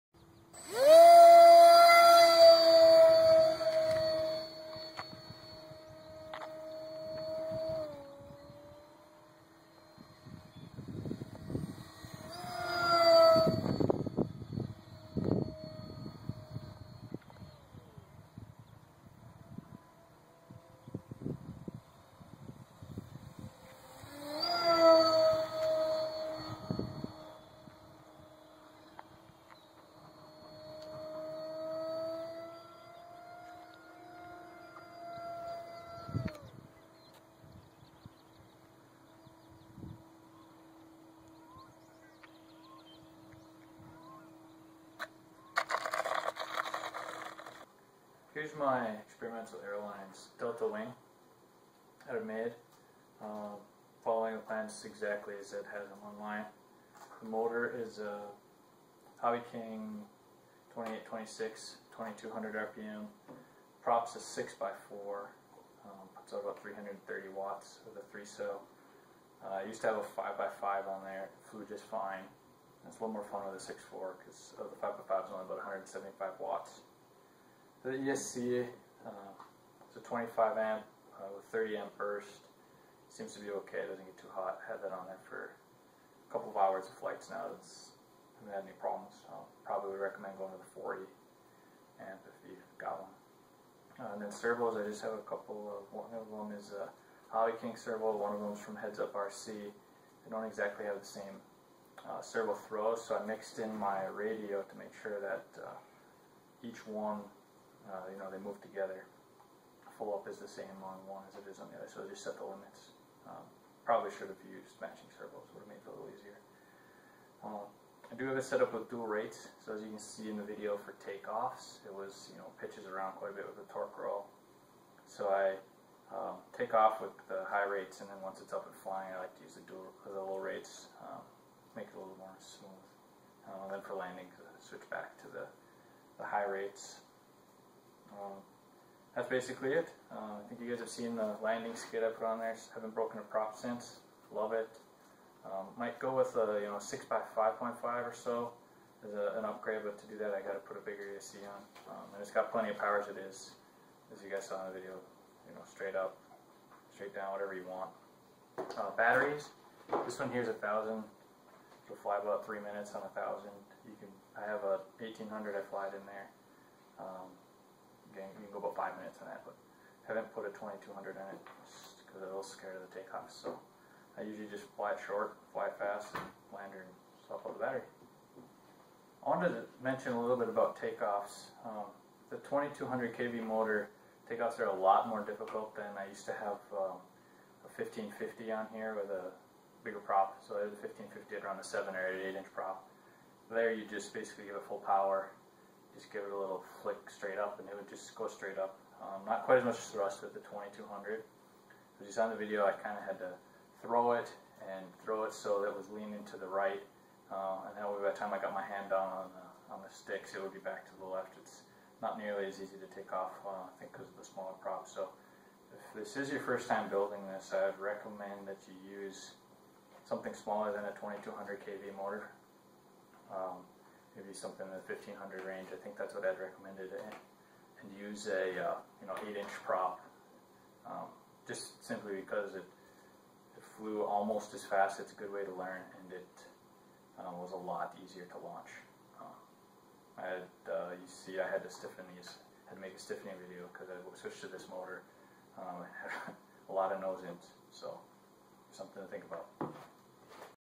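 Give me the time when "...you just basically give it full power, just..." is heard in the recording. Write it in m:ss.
3:13.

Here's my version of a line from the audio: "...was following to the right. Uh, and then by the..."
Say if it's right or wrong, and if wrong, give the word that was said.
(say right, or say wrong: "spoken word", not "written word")
wrong: "leaning", not "following".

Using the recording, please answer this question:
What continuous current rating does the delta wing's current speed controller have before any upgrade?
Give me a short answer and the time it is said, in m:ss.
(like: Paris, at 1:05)
25 amp, at 1:20.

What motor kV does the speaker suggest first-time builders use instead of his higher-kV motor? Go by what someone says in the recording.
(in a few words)
1500.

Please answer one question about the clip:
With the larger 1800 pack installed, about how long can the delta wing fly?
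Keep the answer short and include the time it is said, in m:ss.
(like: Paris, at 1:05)
5 minutes, at 2:48.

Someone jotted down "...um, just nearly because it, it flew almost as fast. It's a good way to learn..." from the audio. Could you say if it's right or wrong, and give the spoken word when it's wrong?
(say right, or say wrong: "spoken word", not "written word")
wrong: "simply", not "nearly".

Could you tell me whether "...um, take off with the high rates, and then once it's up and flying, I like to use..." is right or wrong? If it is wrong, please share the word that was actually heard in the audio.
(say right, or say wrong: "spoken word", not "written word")
right.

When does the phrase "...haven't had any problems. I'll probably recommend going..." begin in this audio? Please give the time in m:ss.
1:28.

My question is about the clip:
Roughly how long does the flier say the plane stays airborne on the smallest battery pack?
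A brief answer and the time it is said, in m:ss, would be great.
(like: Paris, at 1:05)
3 minutes, at 2:42.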